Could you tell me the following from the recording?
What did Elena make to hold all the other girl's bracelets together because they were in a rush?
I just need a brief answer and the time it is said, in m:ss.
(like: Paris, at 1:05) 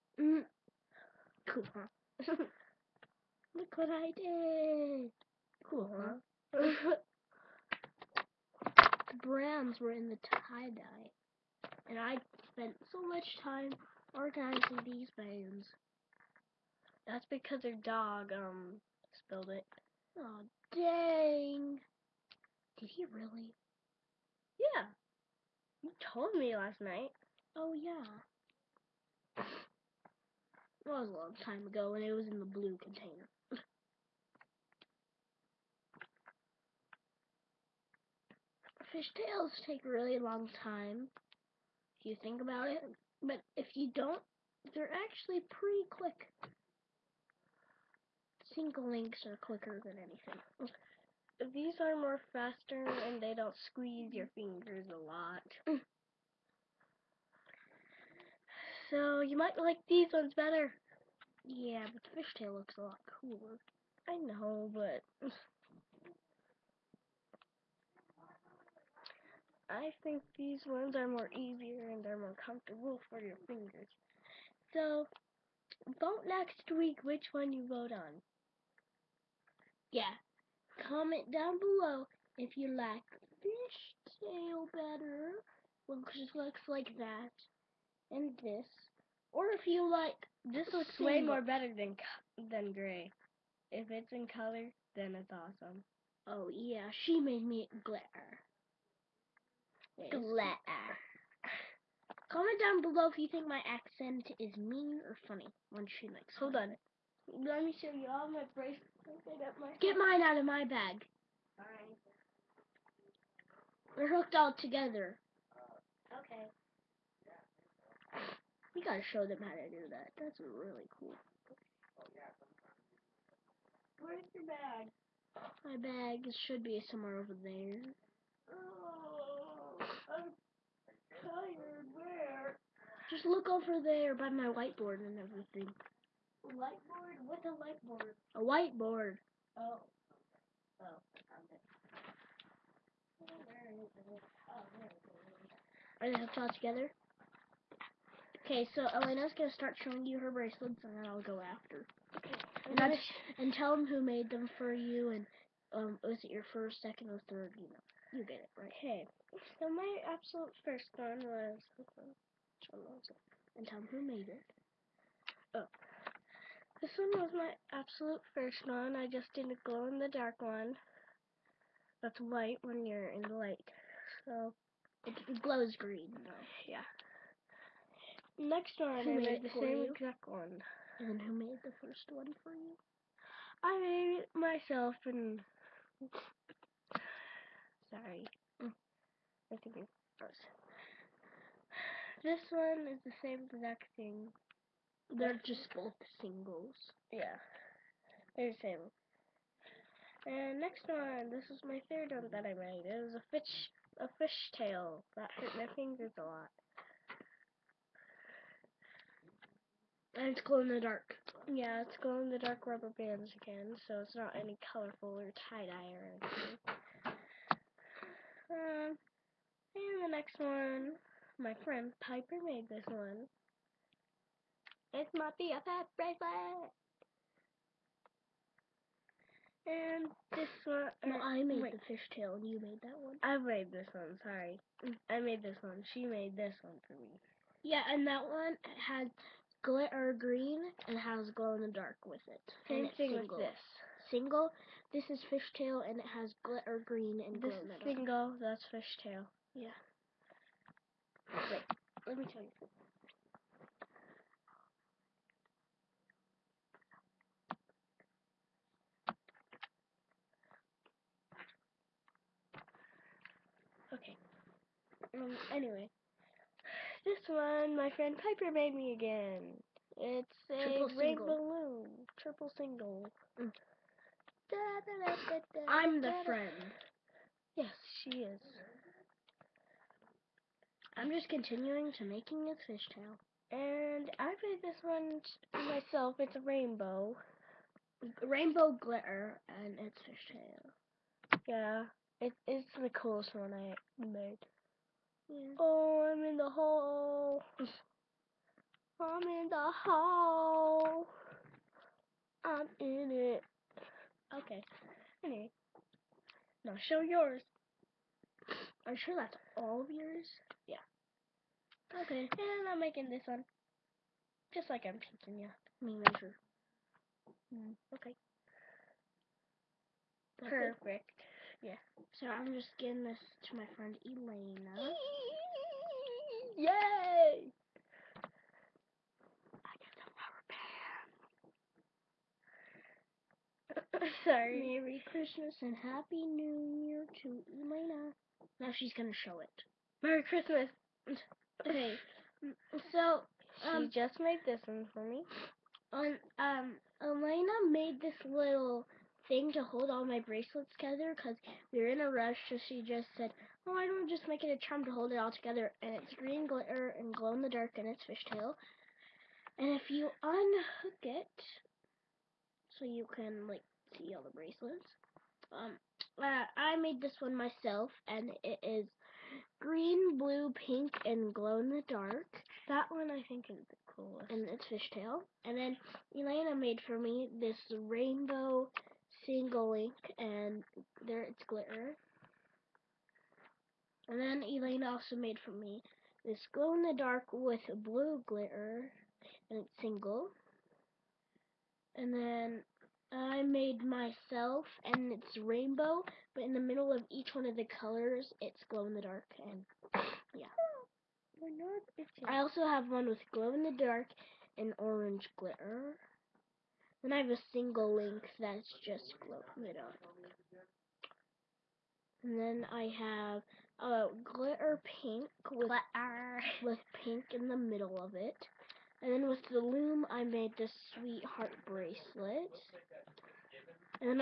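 A charm, at 5:54.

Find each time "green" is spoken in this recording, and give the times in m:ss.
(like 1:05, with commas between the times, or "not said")
2:55, 4:00, 4:06, 5:56, 6:09.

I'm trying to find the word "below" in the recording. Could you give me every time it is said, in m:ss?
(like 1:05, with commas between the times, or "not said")
1:21, 1:42.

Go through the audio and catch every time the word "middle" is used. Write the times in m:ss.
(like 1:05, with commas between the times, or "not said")
6:36, 6:57.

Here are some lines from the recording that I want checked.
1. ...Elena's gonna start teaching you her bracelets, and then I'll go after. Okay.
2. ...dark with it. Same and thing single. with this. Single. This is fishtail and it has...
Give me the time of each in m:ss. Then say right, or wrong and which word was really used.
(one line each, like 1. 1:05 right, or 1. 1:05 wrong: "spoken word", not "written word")
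1. 2:28 wrong: "showing", not "teaching"
2. 4:01 right.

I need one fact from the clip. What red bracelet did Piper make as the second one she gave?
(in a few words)
Triple red balloon.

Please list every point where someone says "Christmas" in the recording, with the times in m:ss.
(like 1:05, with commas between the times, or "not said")
5:35, 5:40.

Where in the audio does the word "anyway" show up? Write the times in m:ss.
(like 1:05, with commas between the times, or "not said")
4:25, 5:05.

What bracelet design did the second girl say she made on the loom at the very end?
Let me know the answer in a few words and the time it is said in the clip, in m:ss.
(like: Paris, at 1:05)
Sweetheart bracelet, at 7:00.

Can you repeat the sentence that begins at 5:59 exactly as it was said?
And if you unhook it, so you can like see all the bracelets.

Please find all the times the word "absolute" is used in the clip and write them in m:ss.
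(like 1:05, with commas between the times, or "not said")
2:40, 2:47.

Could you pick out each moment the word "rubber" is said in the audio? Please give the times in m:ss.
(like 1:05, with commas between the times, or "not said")
3:32, 5:33.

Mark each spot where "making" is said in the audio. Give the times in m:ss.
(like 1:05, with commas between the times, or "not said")
4:42, 5:12.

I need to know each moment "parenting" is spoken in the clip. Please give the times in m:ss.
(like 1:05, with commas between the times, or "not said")
not said.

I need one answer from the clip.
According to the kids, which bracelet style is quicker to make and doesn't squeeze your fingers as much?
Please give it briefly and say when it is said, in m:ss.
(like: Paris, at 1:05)
Single links, at 0:48.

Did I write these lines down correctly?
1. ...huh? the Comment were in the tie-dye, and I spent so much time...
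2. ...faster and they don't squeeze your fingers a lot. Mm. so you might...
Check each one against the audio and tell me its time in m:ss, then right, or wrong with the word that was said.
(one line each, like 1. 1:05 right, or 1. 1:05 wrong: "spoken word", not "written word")
1. 0:05 wrong: "Browns", not "Comment"
2. 0:52 right.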